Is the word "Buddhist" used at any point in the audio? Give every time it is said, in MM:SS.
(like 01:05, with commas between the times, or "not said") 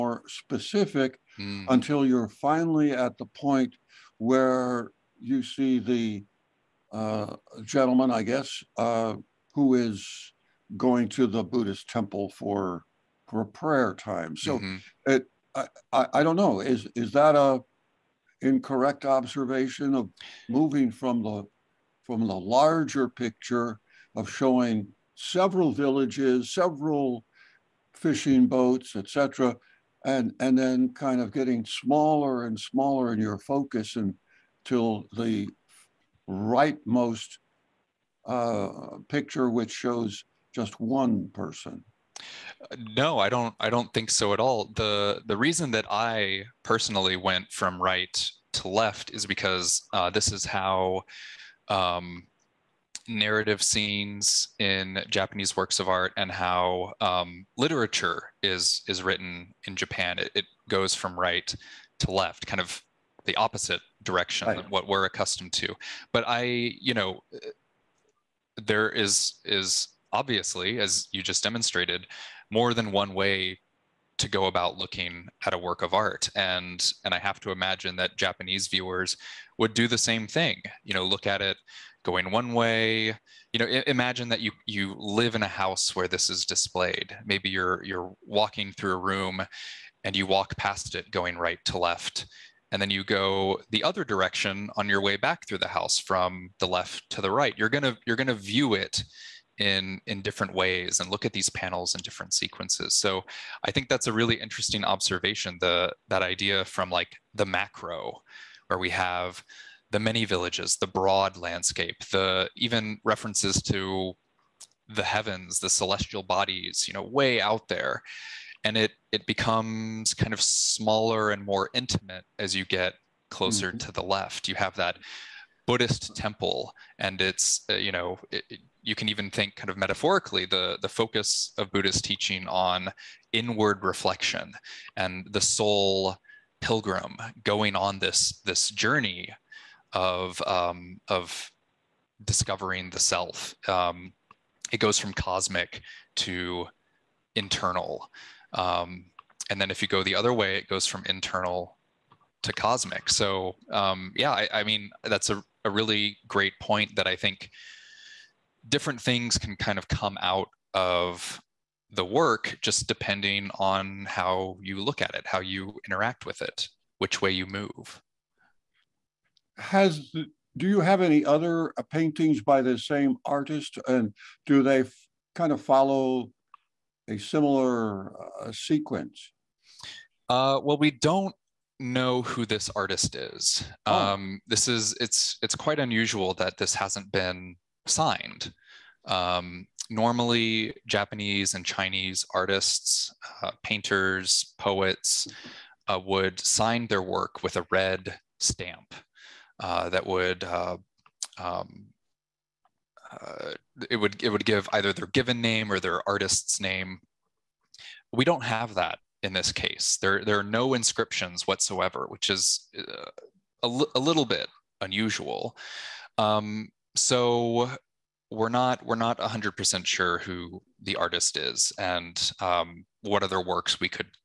00:11, 02:05, 02:11.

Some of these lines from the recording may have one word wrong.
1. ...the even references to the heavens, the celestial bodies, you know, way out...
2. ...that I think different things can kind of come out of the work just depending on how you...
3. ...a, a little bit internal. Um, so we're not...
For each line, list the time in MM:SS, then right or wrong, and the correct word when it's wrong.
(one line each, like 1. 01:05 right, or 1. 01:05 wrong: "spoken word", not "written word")
1. 01:52 right
2. 02:36 right
3. 03:33 wrong: "unusual", not "internal".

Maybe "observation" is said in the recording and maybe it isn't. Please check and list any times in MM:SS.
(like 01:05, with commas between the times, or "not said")
00:19, 01:44.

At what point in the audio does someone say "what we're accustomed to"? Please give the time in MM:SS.
01:04.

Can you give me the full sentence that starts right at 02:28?
Um, and then if you go the other way, it goes from internal to cosmic.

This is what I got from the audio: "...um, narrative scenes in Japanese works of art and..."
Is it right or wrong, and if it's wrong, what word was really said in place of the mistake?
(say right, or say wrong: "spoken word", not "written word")
right.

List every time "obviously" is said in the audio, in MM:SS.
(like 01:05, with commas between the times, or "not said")
01:10.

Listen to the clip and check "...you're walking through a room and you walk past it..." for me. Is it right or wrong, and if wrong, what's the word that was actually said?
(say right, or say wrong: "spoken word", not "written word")
right.